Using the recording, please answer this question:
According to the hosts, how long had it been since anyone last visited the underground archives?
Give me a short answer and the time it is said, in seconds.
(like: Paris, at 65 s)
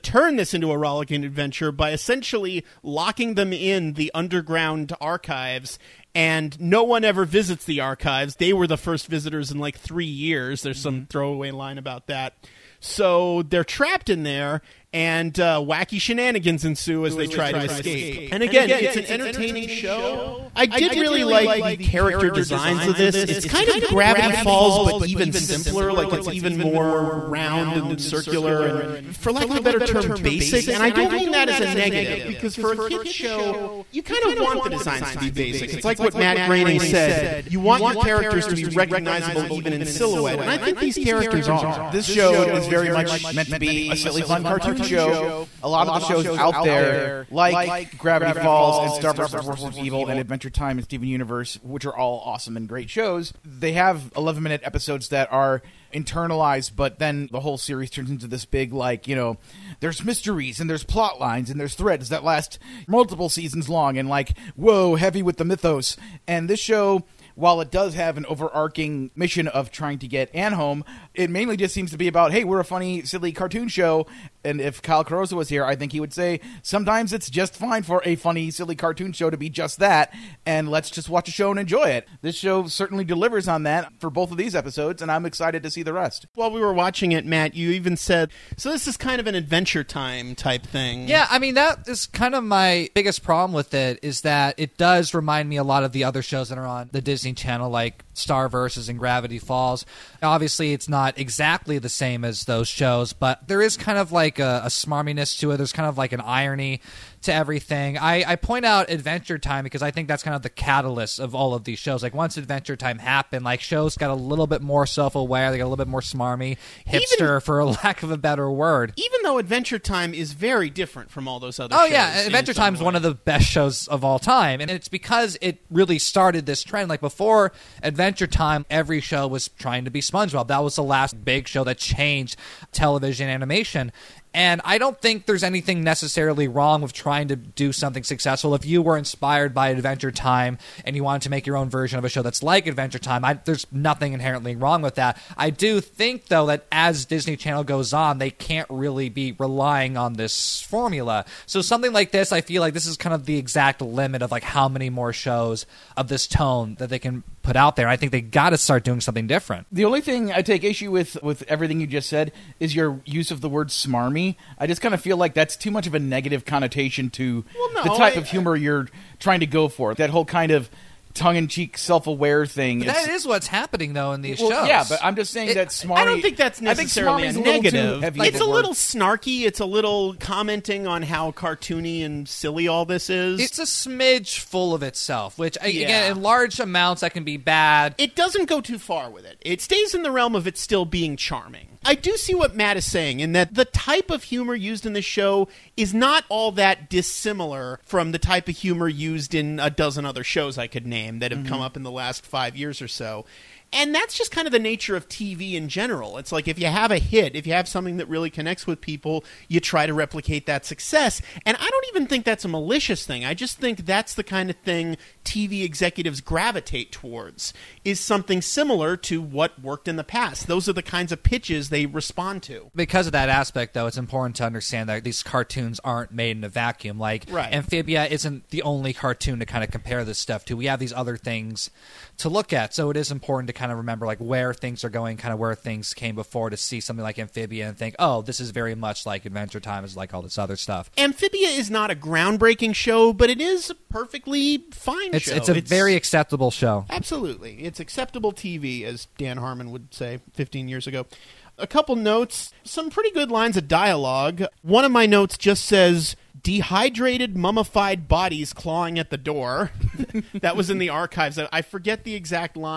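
3 years, at 9 s.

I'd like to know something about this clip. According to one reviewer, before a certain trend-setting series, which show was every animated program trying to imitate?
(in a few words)
SpongeBob.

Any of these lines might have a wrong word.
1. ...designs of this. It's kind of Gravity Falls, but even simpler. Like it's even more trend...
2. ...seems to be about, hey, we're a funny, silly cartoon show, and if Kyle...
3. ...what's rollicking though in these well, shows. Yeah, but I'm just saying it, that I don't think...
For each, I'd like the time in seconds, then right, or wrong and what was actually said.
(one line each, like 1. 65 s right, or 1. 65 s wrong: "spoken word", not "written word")
1. 22 s wrong: "round", not "trend"
2. 71 s right
3. 173 s wrong: "happening", not "rollicking".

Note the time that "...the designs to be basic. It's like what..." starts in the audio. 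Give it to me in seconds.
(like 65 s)
34 s.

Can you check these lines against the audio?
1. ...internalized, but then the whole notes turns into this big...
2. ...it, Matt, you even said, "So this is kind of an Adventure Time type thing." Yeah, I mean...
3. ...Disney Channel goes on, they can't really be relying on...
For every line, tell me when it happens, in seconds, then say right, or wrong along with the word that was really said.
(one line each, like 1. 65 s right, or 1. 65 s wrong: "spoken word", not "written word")
1. 55 s wrong: "series", not "notes"
2. 87 s right
3. 147 s right.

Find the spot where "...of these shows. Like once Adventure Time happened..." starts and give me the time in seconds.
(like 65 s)
111 s.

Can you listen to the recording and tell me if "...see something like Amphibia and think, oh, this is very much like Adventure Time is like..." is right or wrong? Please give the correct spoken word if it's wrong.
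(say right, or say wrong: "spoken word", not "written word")
right.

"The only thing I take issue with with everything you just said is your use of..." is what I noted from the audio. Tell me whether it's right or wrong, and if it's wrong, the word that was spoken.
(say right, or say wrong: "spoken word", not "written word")
right.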